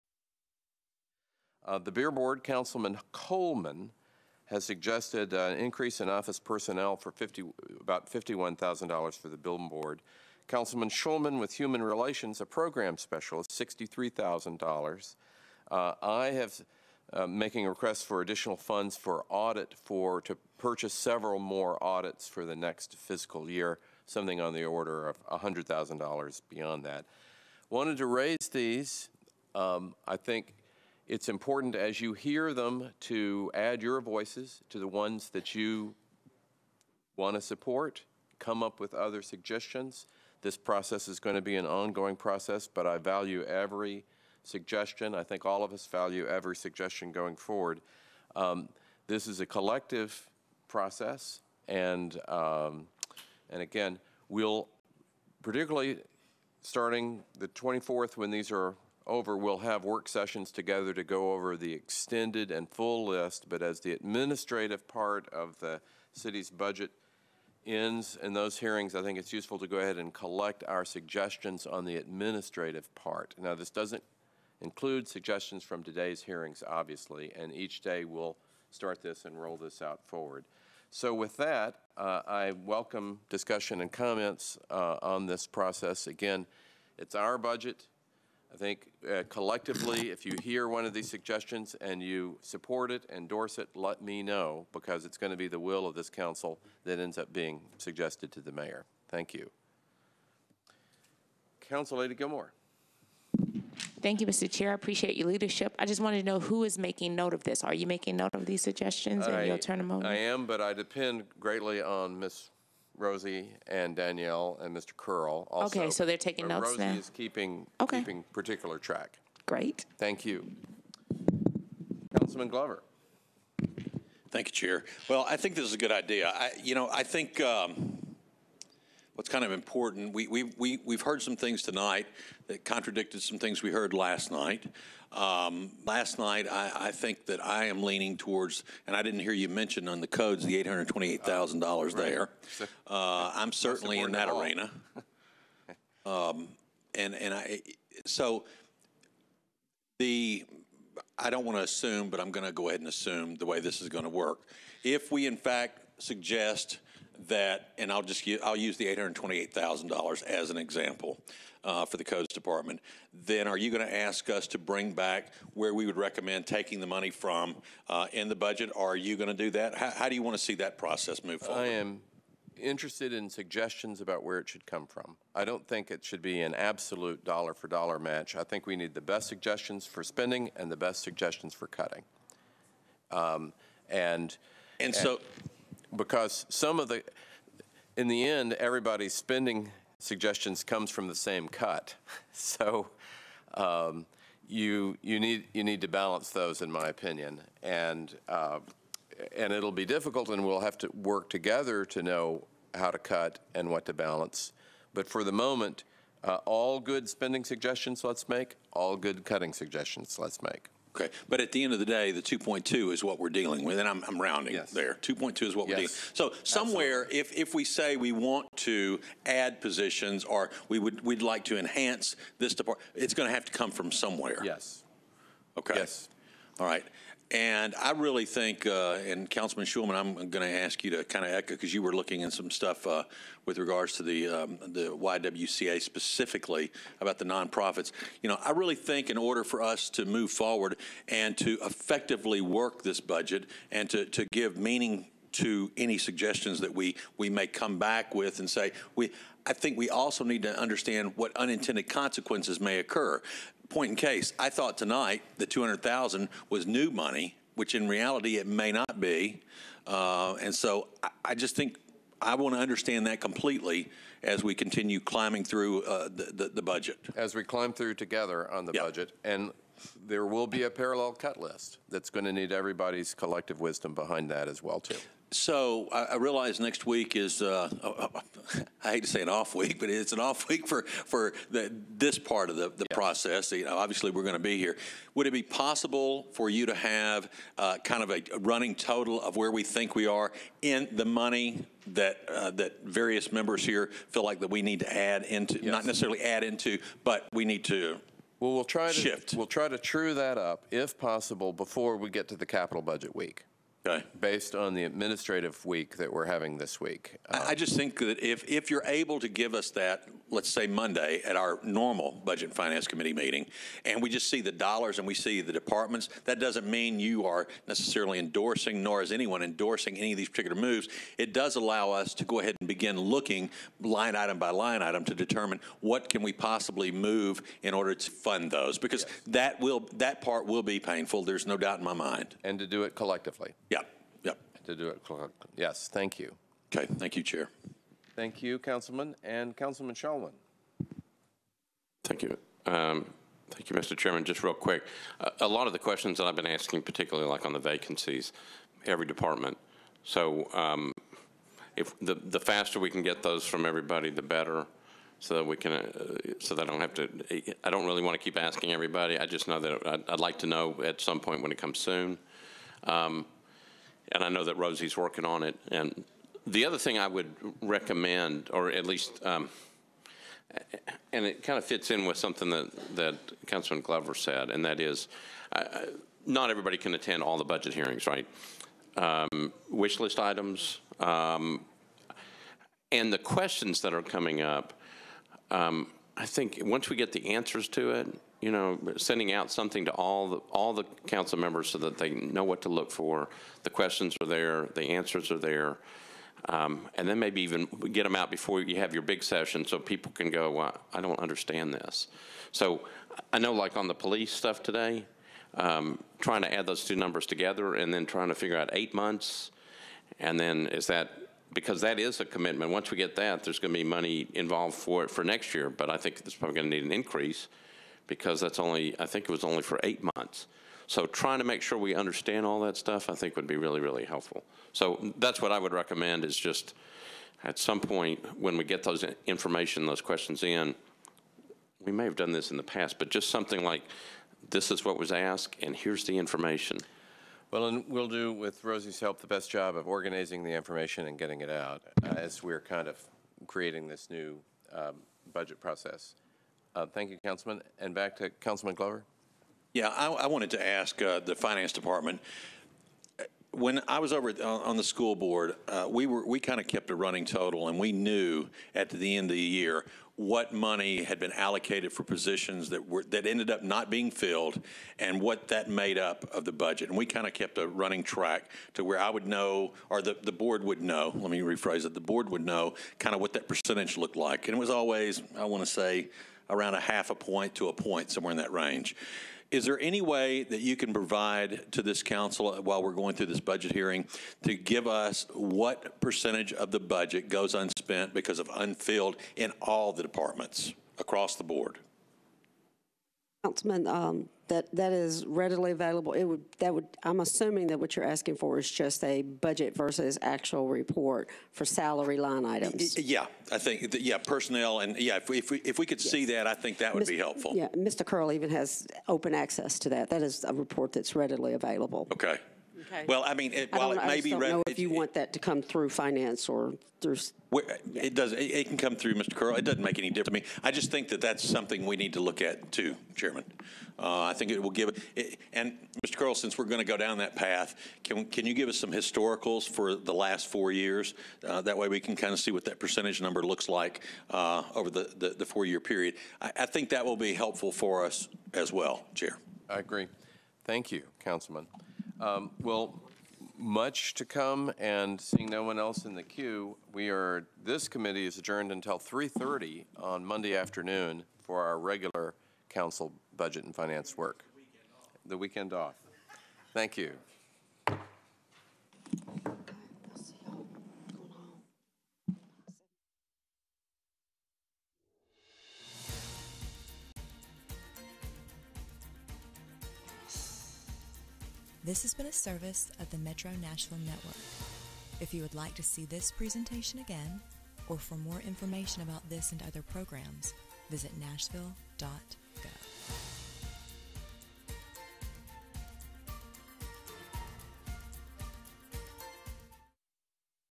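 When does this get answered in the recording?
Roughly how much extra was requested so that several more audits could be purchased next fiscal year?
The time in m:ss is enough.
0:25.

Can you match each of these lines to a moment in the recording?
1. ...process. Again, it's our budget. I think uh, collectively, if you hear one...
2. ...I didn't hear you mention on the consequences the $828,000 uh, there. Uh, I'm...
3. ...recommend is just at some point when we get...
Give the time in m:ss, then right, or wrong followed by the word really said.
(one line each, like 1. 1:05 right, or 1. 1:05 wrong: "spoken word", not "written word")
1. 1:25 right
2. 2:18 wrong: "codes", not "consequences"
3. 7:05 right.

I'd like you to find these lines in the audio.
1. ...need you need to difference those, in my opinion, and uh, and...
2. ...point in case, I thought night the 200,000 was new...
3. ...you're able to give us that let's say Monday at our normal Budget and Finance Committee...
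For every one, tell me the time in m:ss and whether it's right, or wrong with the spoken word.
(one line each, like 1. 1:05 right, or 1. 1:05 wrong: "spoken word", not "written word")
1. 3:15 wrong: "balance", not "difference"
2. 4:13 wrong: "tonight", not "night"
3. 5:08 right.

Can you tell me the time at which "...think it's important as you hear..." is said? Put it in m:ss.
0:30.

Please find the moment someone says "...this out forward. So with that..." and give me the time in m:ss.
1:19.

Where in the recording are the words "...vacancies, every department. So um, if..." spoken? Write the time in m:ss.
5:47.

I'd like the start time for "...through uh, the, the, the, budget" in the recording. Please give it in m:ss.
4:25.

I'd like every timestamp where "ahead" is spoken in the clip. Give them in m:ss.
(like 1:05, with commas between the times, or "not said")
1:09, 2:32, 5:22.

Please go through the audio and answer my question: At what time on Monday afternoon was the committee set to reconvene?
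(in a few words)
3:30.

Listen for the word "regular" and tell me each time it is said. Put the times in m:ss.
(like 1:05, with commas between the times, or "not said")
9:11.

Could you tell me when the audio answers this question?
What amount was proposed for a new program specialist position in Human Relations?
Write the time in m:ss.
0:13.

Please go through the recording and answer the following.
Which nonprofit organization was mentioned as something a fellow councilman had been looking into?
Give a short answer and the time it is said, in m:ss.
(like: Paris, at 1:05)
YWCA, at 3:54.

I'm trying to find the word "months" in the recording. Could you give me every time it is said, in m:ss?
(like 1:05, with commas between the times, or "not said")
6:48, 7:00.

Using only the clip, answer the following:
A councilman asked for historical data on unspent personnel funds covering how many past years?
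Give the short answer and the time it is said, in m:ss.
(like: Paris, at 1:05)
4, at 8:50.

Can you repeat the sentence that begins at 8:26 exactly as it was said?
see that I think that would Mr.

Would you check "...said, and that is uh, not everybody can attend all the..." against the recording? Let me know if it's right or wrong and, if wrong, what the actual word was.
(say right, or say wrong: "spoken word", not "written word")
right.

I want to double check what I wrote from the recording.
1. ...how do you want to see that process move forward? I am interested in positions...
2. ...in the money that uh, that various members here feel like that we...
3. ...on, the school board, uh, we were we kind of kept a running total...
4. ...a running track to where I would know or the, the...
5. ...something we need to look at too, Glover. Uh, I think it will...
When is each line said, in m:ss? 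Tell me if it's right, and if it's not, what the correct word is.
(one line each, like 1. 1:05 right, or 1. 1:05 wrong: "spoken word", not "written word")
1. 2:49 wrong: "suggestions", not "positions"
2. 4:50 right
3. 7:34 right
4. 7:47 right
5. 8:41 wrong: "Chairman", not "Glover".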